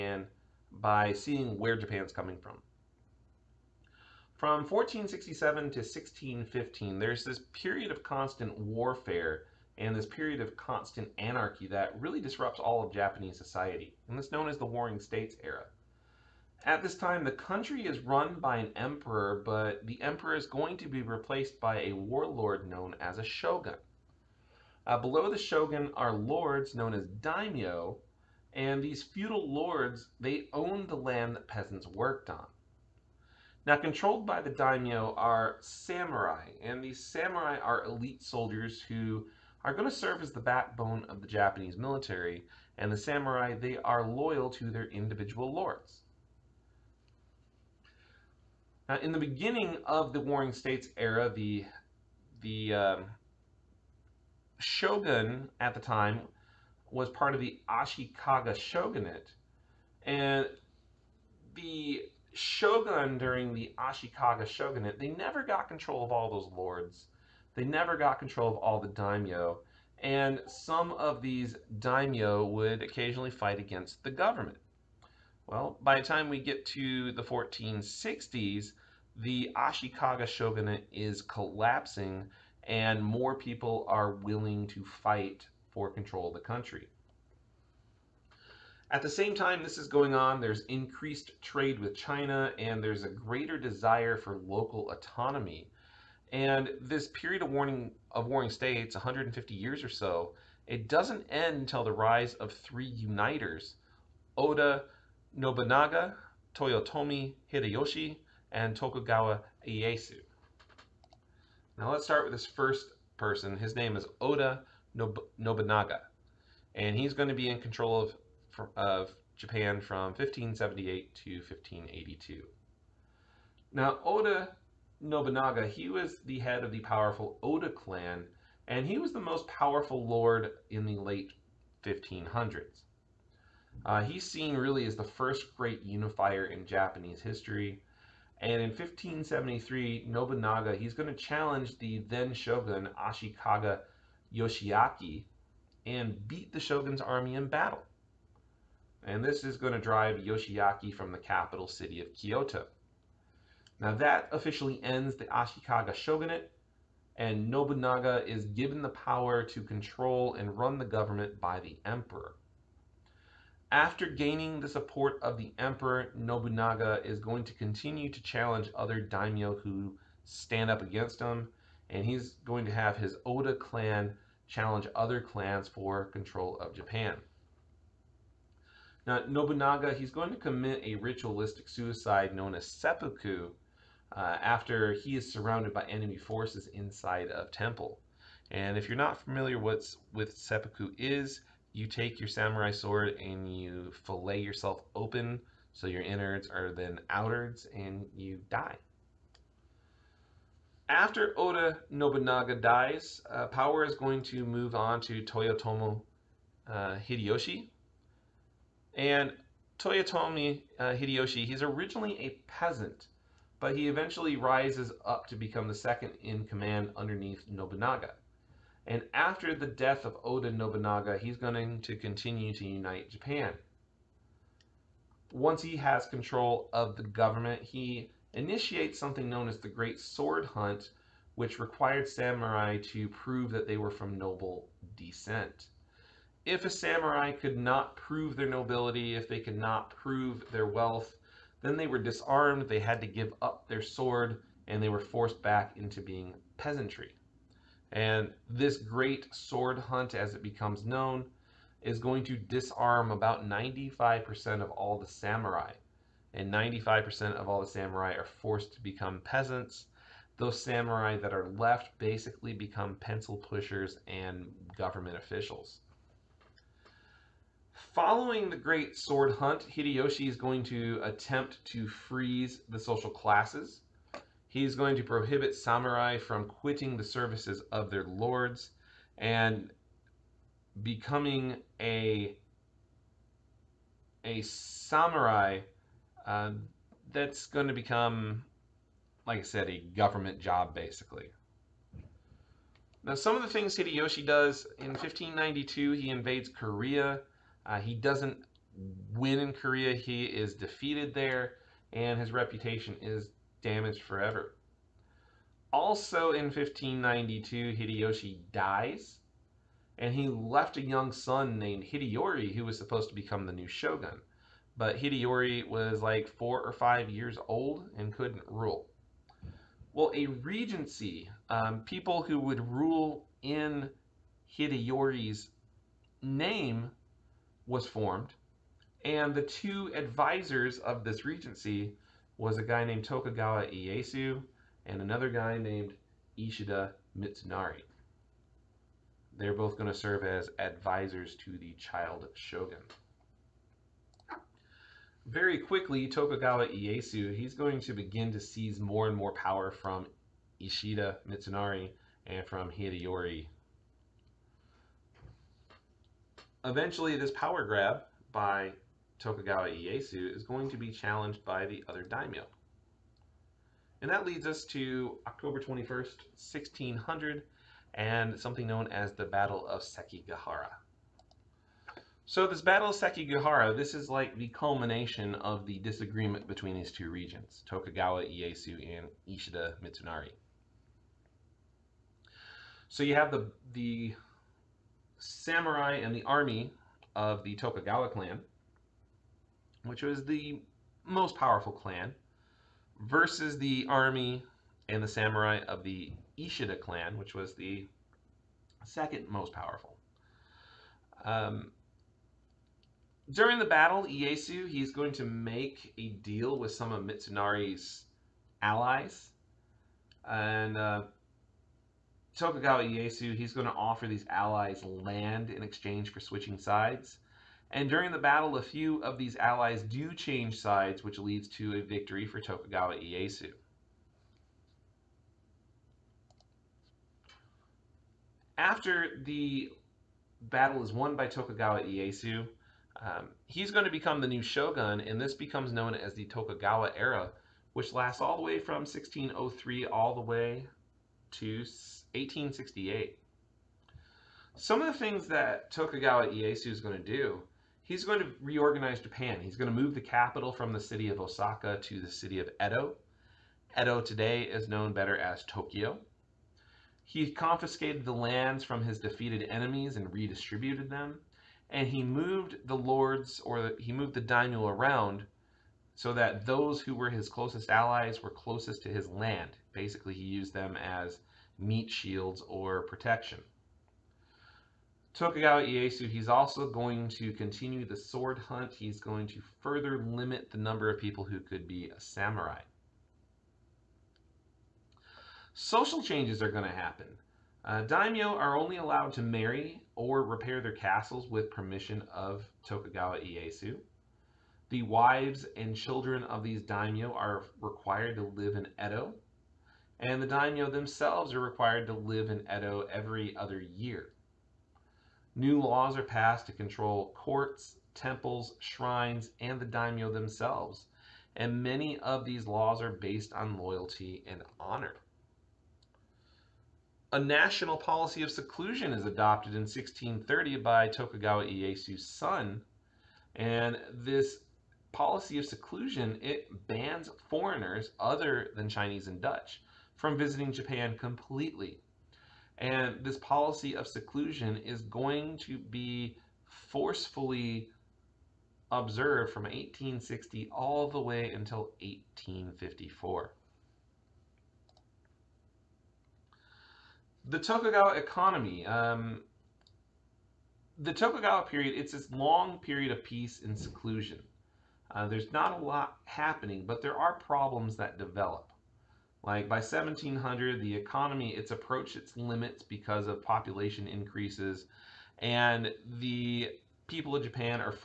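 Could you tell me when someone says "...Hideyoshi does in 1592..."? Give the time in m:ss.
4:53.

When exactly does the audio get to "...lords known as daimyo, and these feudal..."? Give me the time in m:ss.
0:26.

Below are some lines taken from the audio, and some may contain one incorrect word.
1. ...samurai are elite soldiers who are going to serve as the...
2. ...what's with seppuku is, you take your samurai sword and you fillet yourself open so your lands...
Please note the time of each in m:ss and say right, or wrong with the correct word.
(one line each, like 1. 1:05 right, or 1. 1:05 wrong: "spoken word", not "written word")
1. 0:37 right
2. 3:09 wrong: "innards", not "lands".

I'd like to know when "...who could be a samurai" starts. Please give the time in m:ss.
8:01.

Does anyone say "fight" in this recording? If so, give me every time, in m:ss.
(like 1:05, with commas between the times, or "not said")
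1:13, 1:24.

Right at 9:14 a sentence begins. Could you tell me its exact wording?
Uh, there's not a lot happening, but there are problems that develop.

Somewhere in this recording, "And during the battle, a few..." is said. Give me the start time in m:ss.
6:57.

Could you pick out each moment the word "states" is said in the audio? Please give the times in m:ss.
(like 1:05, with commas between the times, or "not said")
0:14, 0:50, 1:38.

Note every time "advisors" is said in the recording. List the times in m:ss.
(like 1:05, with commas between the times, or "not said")
5:29, 5:40.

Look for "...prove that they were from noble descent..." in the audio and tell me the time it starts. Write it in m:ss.
3:53.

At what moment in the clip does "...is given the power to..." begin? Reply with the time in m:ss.
2:38.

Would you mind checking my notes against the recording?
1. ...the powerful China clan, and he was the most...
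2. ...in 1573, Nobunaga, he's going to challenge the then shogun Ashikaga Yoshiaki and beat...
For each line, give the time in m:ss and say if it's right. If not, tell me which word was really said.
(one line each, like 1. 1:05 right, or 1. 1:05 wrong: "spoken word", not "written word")
1. 2:06 wrong: "Oda", not "China"
2. 2:18 right.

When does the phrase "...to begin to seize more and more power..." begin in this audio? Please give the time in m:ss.
5:47.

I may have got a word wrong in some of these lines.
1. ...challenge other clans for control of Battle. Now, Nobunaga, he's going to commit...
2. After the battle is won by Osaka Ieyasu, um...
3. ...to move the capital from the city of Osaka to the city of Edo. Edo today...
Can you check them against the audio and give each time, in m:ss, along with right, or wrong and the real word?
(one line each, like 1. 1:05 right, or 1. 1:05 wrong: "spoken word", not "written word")
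1. 2:54 wrong: "Japan", not "Battle"
2. 7:08 wrong: "Tokugawa", not "Osaka"
3. 7:29 right.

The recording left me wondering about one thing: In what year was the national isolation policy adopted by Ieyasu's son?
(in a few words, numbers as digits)
1630.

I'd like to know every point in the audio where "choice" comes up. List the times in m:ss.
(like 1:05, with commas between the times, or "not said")
not said.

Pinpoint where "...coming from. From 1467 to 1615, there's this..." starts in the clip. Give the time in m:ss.
0:02.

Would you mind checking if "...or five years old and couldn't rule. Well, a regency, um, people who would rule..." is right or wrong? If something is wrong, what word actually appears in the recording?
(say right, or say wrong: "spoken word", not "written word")
right.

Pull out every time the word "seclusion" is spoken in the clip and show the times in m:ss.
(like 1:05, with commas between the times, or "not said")
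8:38, 8:45, 8:53, 9:13.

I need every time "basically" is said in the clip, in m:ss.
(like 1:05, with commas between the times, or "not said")
4:21, 4:50, 7:49.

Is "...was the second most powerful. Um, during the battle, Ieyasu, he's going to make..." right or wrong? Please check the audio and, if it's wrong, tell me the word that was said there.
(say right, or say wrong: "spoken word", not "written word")
right.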